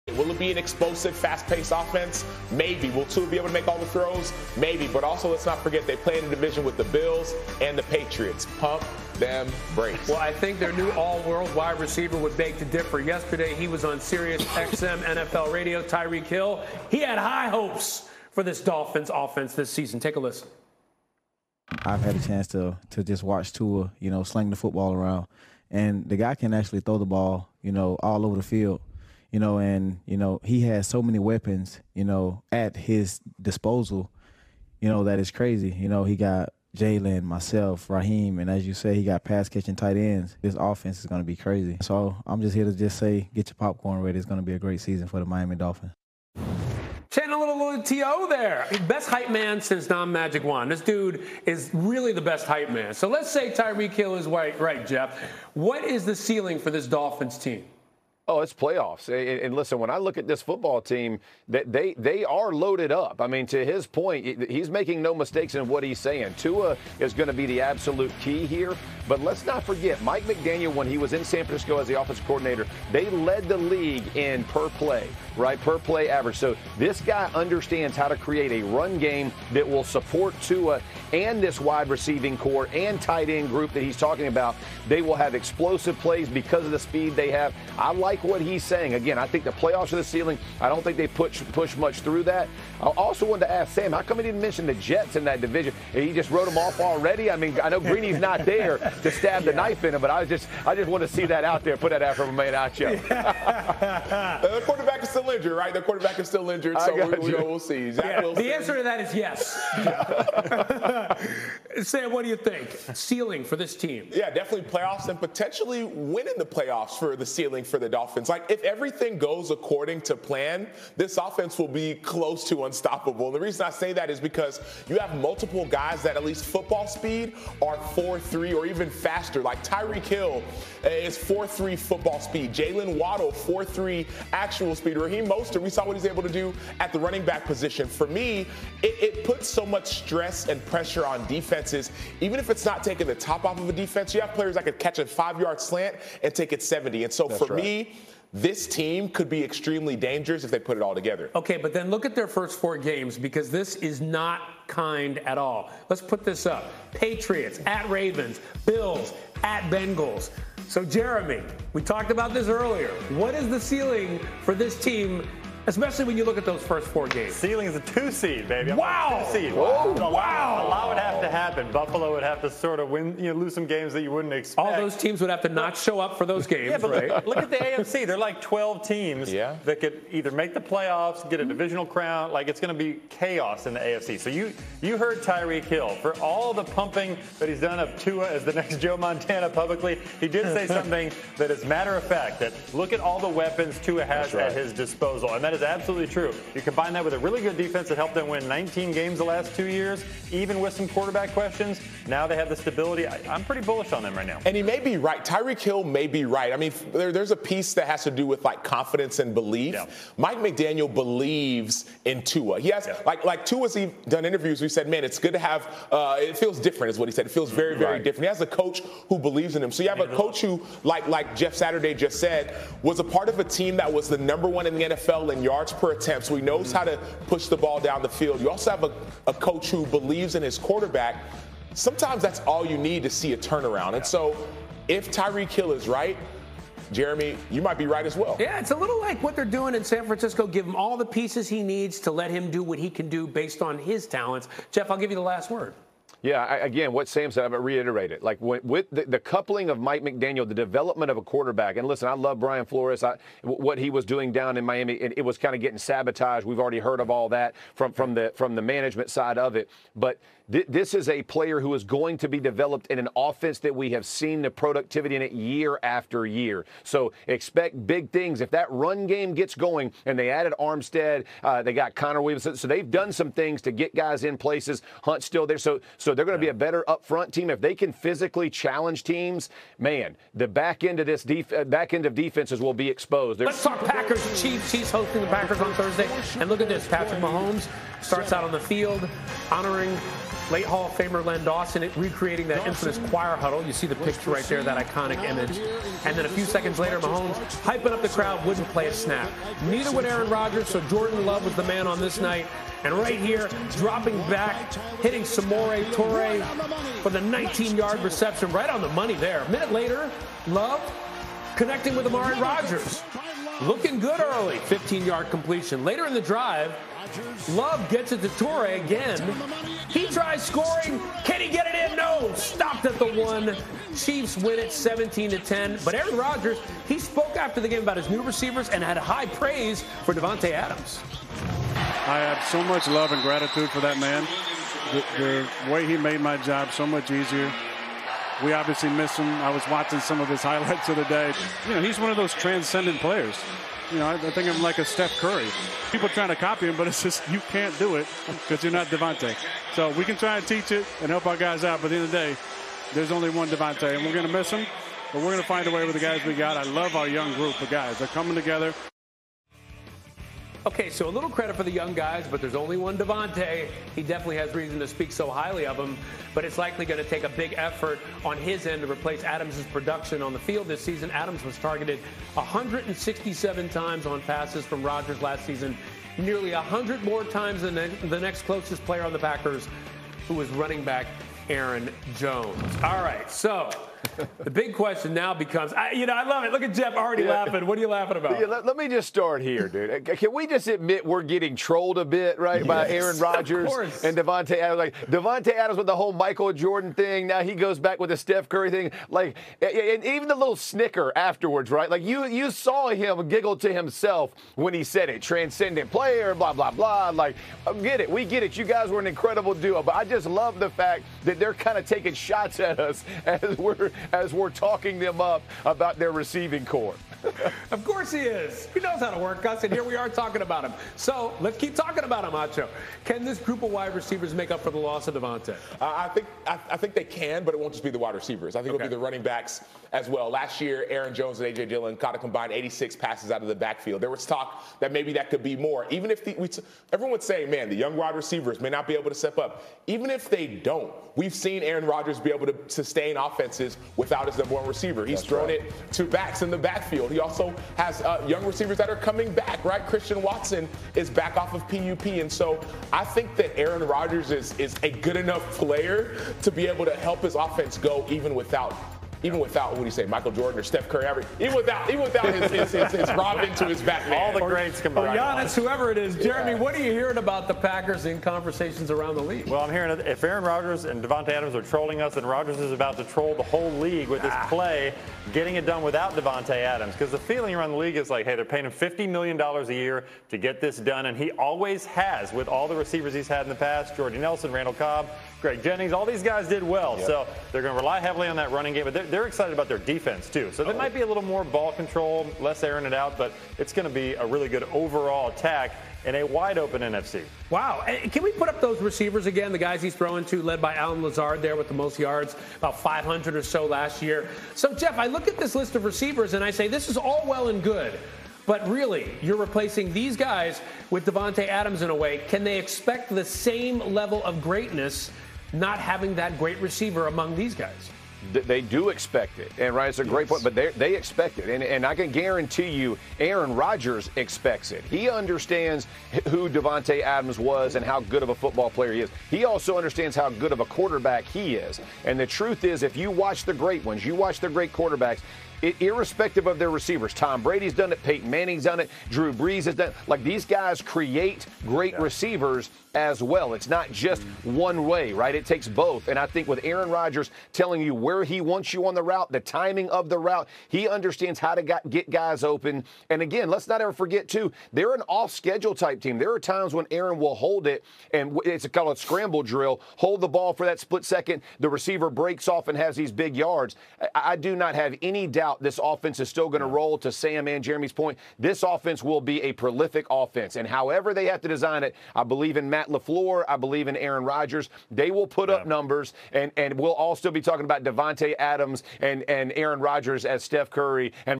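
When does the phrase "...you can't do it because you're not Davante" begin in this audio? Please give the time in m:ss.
5:47.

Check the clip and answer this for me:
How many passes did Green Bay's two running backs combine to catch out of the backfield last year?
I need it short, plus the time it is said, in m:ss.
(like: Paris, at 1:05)
86, at 7:12.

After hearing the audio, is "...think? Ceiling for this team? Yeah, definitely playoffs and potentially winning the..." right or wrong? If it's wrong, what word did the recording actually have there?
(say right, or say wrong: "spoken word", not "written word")
right.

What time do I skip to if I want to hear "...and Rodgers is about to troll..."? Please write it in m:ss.
7:52.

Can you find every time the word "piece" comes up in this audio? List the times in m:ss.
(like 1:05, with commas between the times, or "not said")
3:27, 4:01.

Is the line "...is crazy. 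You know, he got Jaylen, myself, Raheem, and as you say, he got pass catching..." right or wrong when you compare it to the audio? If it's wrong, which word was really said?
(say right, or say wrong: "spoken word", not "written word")
right.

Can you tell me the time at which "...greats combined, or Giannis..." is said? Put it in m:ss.
7:44.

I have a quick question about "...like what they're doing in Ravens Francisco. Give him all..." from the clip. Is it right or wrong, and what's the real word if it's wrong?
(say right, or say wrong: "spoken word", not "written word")
wrong: "San", not "Ravens".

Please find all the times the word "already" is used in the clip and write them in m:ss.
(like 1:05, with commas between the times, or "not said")
1:36, 4:16, 6:26.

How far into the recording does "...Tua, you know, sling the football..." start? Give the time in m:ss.
0:23.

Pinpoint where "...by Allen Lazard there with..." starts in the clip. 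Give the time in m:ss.
8:20.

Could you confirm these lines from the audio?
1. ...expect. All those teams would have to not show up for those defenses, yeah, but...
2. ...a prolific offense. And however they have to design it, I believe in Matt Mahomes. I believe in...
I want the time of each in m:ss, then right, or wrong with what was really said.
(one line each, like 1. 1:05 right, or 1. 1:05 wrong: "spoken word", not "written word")
1. 2:54 wrong: "games", not "defenses"
2. 9:29 wrong: "LaFleur", not "Mahomes".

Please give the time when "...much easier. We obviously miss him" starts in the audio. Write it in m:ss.
5:36.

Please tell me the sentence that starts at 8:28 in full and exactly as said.
But really, you're replacing these guys with Davante Adams in a way.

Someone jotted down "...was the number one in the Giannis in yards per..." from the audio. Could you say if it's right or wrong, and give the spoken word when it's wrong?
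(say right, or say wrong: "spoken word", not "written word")
wrong: "NFL", not "Giannis".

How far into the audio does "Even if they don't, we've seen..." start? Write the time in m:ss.
7:19.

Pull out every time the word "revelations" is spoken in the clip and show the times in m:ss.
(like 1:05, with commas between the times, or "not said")
not said.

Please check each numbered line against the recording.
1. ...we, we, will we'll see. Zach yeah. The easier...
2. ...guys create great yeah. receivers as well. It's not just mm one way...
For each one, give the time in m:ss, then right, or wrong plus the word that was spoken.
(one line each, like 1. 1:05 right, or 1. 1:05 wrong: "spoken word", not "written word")
1. 1:46 wrong: "answer", not "easier"
2. 9:00 right.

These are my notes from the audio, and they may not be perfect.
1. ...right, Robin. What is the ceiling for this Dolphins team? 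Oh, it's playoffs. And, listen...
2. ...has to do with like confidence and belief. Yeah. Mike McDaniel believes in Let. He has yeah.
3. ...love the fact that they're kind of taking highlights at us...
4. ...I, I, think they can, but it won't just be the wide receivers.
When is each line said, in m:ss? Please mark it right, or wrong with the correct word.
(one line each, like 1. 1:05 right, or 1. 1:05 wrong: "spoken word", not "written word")
1. 0:54 wrong: "Jeff", not "Robin"
2. 3:27 wrong: "Tua", not "Let"
3. 6:50 wrong: "shots", not "highlights"
4. 7:06 right.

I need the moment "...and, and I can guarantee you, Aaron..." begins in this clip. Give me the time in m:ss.
8:41.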